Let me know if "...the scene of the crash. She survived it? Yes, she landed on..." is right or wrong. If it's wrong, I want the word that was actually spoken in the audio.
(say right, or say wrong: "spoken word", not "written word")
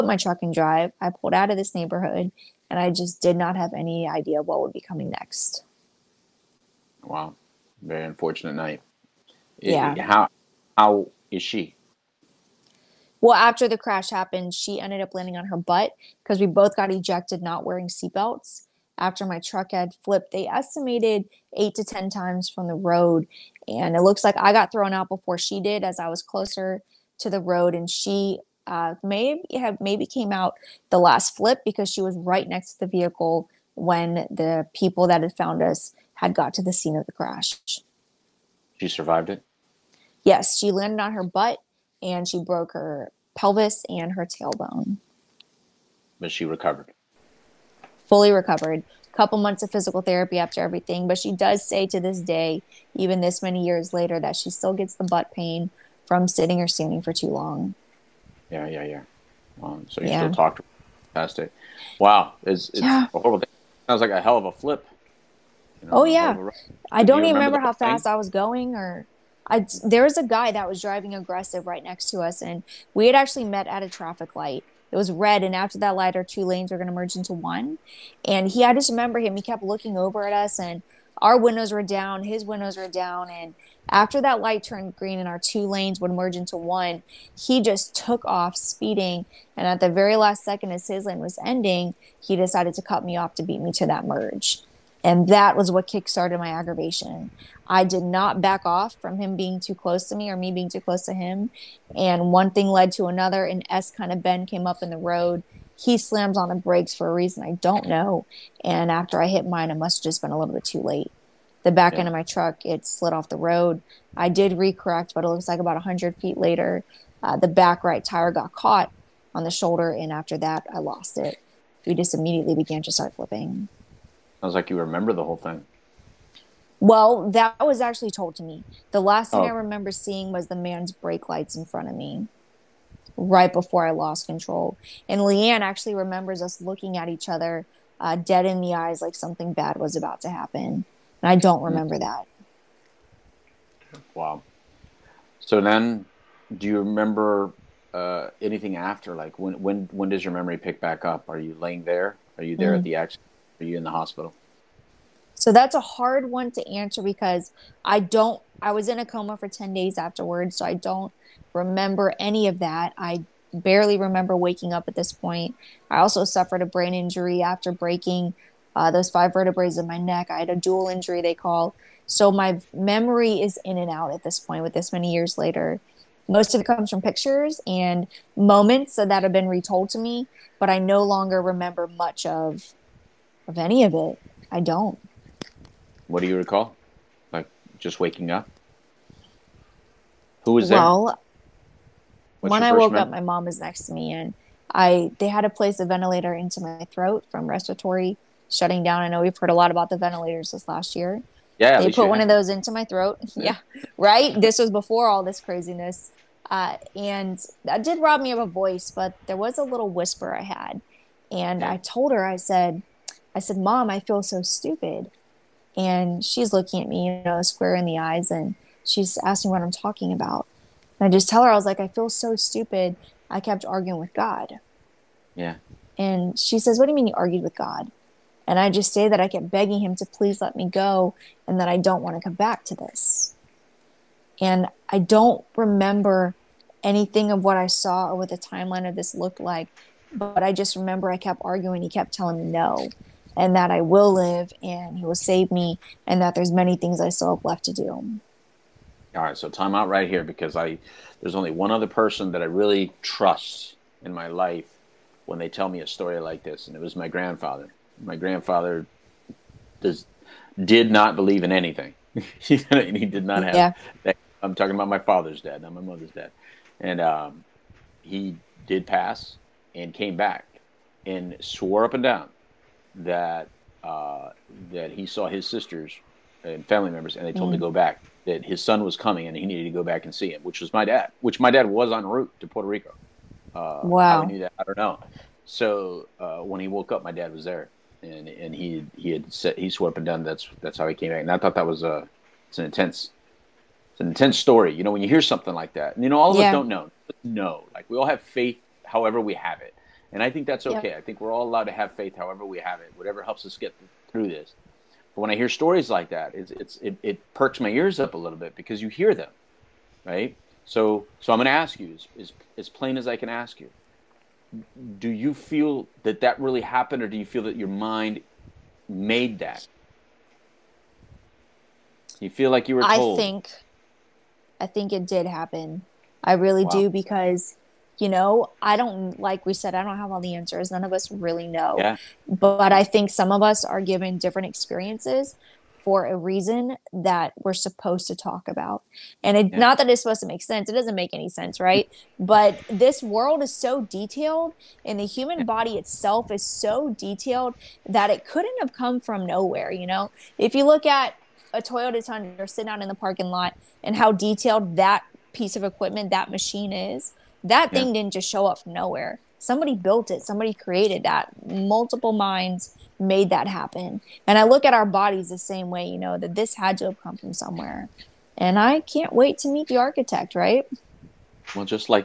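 right.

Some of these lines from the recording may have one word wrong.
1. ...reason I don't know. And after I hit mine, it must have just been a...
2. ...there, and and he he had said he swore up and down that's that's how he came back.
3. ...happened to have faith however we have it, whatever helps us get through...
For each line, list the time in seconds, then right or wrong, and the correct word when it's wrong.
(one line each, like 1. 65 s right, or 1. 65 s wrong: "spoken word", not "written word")
1. 107 s right
2. 287 s right
3. 301 s wrong: "allowed", not "happened".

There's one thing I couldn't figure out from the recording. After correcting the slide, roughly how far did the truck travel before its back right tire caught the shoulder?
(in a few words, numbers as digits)
100 feet.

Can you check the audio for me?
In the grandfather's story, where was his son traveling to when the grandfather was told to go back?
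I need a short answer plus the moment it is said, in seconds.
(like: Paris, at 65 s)
Puerto Rico, at 282 s.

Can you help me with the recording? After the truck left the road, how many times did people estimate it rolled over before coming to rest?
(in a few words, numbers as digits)
8 to 10.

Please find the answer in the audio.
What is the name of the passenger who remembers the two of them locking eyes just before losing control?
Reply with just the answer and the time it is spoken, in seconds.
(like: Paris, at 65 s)
Leanne, at 135 s.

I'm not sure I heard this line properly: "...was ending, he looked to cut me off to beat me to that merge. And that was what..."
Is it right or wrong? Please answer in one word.
wrong.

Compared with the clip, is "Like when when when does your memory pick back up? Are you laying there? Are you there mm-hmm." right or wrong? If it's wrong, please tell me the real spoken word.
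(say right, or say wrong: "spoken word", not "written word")
right.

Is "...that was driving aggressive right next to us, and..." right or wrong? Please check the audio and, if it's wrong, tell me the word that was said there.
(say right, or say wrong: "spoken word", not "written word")
right.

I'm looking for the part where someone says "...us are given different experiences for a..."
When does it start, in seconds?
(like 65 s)
333 s.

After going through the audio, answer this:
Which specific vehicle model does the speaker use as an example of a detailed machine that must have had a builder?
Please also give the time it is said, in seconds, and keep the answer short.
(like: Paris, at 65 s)
Toyota Tundra, at 351 s.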